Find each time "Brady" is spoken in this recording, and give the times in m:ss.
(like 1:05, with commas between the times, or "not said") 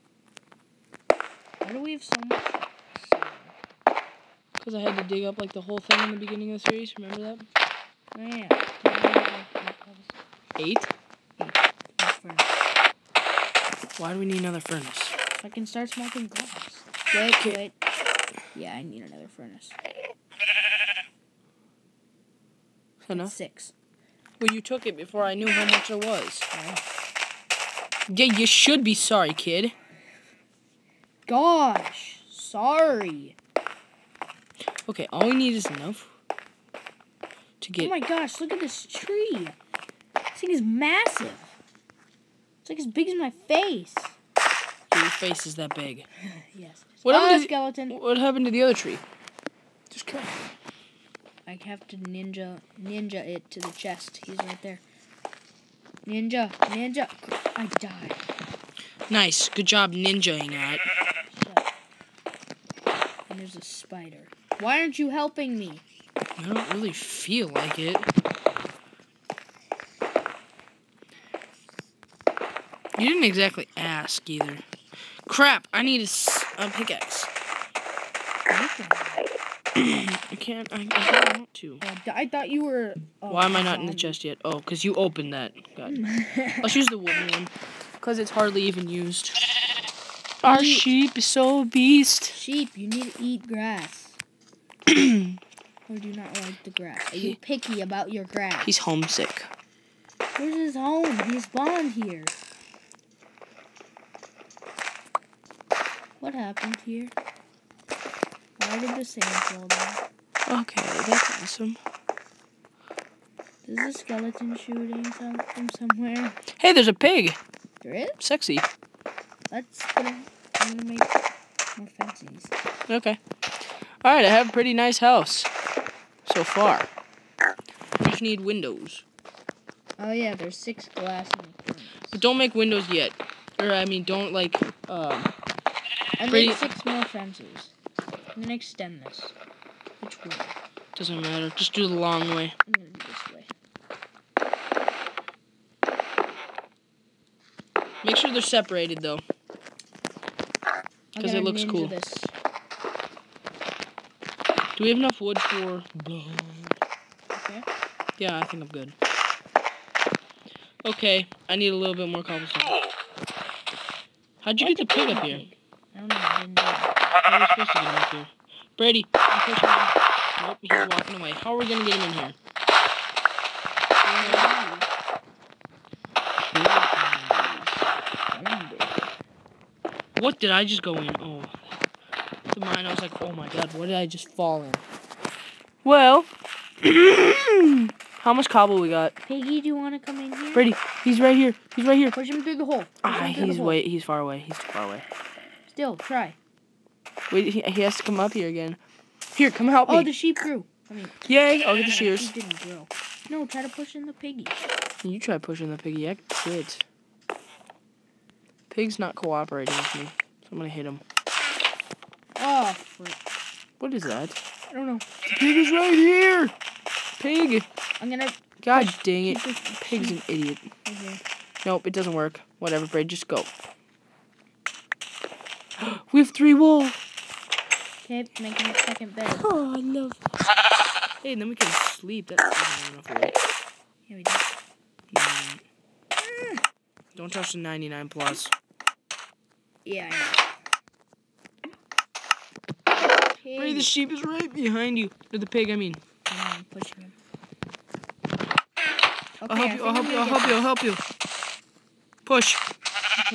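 2:48, 3:10.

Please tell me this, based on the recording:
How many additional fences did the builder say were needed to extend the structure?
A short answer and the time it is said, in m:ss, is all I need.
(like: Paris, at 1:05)
6, at 2:16.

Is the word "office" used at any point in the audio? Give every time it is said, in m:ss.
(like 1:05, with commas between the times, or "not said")
not said.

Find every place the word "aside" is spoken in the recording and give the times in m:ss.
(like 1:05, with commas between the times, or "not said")
not said.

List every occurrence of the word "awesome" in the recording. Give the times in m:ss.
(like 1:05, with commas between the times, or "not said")
1:51.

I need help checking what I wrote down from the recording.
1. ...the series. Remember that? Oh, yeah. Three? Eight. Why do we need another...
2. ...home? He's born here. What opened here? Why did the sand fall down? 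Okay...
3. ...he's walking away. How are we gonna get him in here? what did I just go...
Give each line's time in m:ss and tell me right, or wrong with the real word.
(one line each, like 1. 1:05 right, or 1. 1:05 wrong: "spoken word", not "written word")
1. 0:06 wrong: "Eight", not "Three"
2. 1:40 wrong: "happened", not "opened"
3. 2:50 right.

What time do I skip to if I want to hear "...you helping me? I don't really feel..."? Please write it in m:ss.
1:04.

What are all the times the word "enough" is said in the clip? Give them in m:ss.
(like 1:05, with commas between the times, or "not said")
0:23, 0:35, 2:34, 3:52.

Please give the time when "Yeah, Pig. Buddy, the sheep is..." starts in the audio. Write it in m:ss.
3:59.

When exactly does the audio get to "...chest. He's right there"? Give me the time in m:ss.
0:53.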